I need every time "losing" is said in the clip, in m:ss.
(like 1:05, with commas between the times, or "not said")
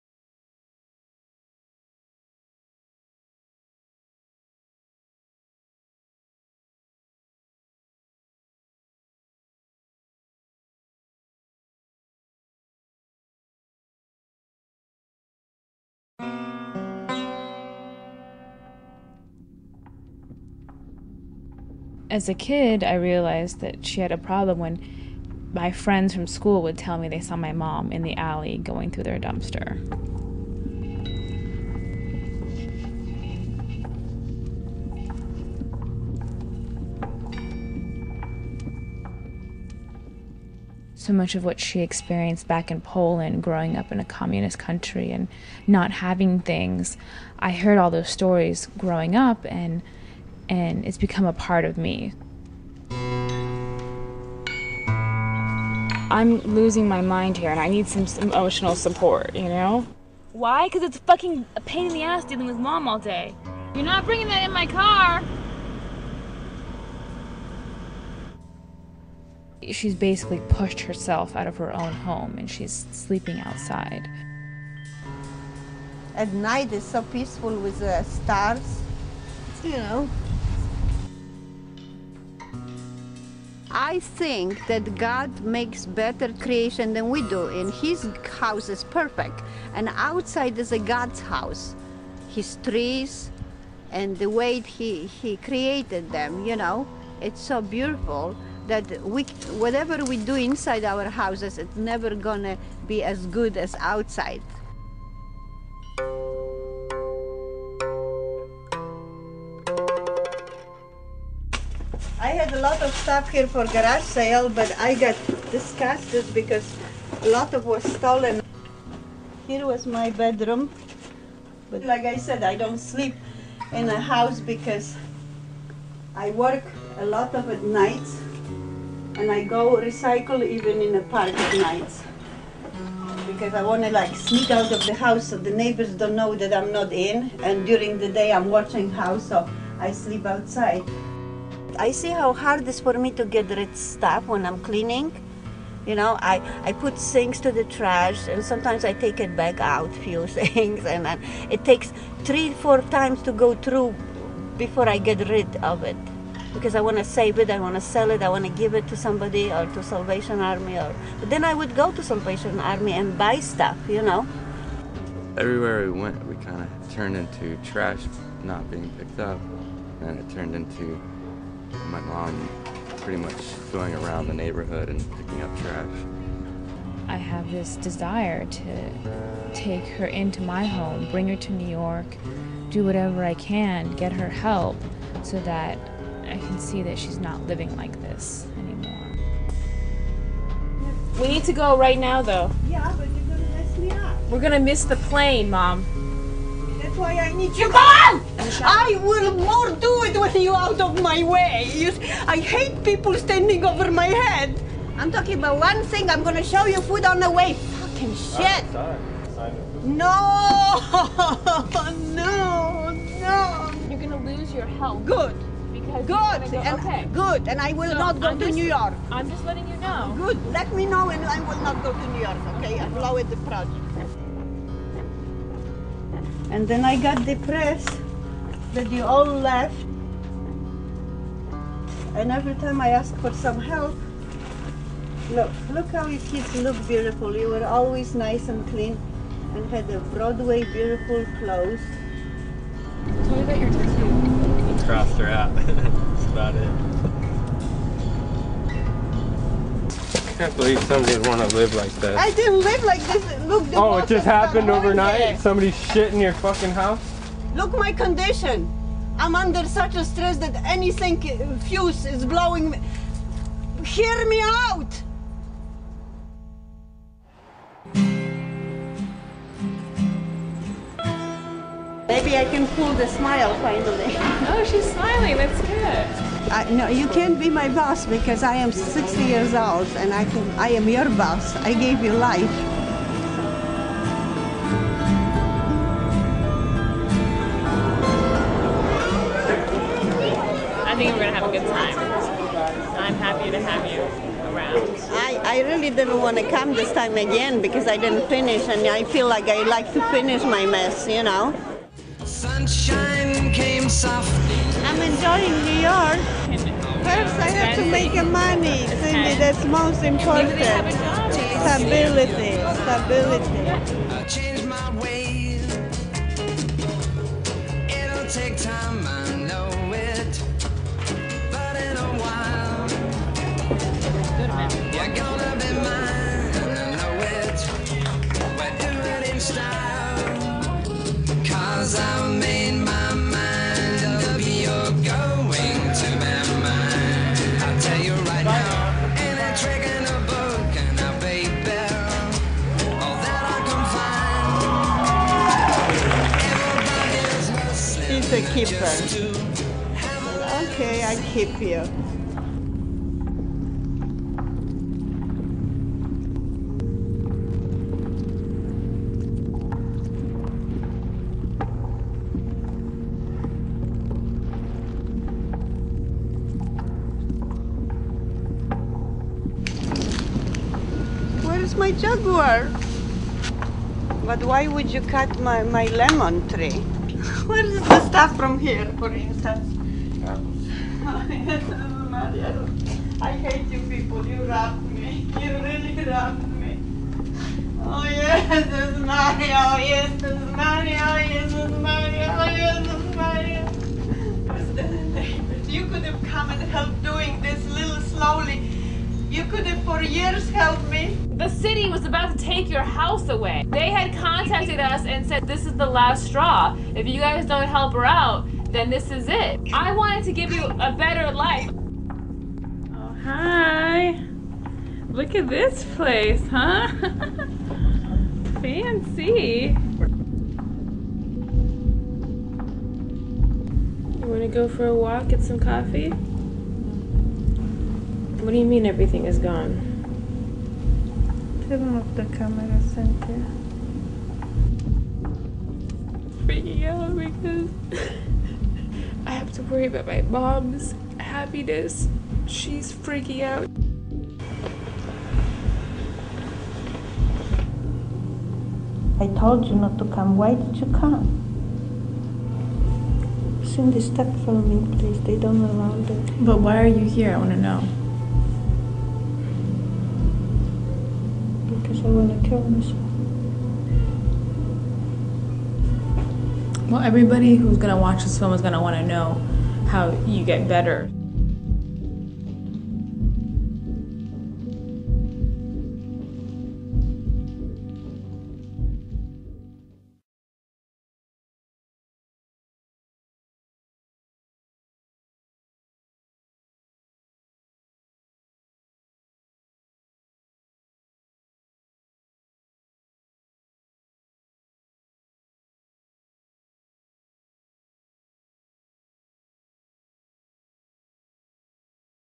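0:56.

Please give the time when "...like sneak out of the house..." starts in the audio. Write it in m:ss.
2:13.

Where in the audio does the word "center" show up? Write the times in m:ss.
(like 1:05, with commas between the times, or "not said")
7:12.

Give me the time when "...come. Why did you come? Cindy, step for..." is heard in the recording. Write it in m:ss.
7:30.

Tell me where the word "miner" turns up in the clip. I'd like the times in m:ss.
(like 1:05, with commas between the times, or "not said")
not said.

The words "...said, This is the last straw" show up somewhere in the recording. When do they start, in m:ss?
6:45.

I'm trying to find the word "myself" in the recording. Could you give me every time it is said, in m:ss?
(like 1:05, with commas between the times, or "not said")
7:42.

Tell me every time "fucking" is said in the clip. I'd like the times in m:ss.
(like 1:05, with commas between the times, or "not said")
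1:00, 3:27, 4:16.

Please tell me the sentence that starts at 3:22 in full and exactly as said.
I hate people standing over my head.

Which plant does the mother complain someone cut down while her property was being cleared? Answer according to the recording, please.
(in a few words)
Lemon tree.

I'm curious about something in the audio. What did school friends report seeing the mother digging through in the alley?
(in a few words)
Their dumpster.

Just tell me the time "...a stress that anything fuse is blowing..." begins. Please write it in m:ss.
4:19.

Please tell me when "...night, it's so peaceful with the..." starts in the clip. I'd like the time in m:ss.
1:16.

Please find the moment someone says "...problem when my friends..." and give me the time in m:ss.
0:24.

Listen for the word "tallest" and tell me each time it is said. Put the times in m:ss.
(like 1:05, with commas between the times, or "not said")
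not said.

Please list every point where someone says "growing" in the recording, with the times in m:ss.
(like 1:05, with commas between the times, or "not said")
0:43, 0:48.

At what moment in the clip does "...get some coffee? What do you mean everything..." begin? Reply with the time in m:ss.
7:05.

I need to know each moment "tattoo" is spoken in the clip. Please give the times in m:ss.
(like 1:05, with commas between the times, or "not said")
4:03.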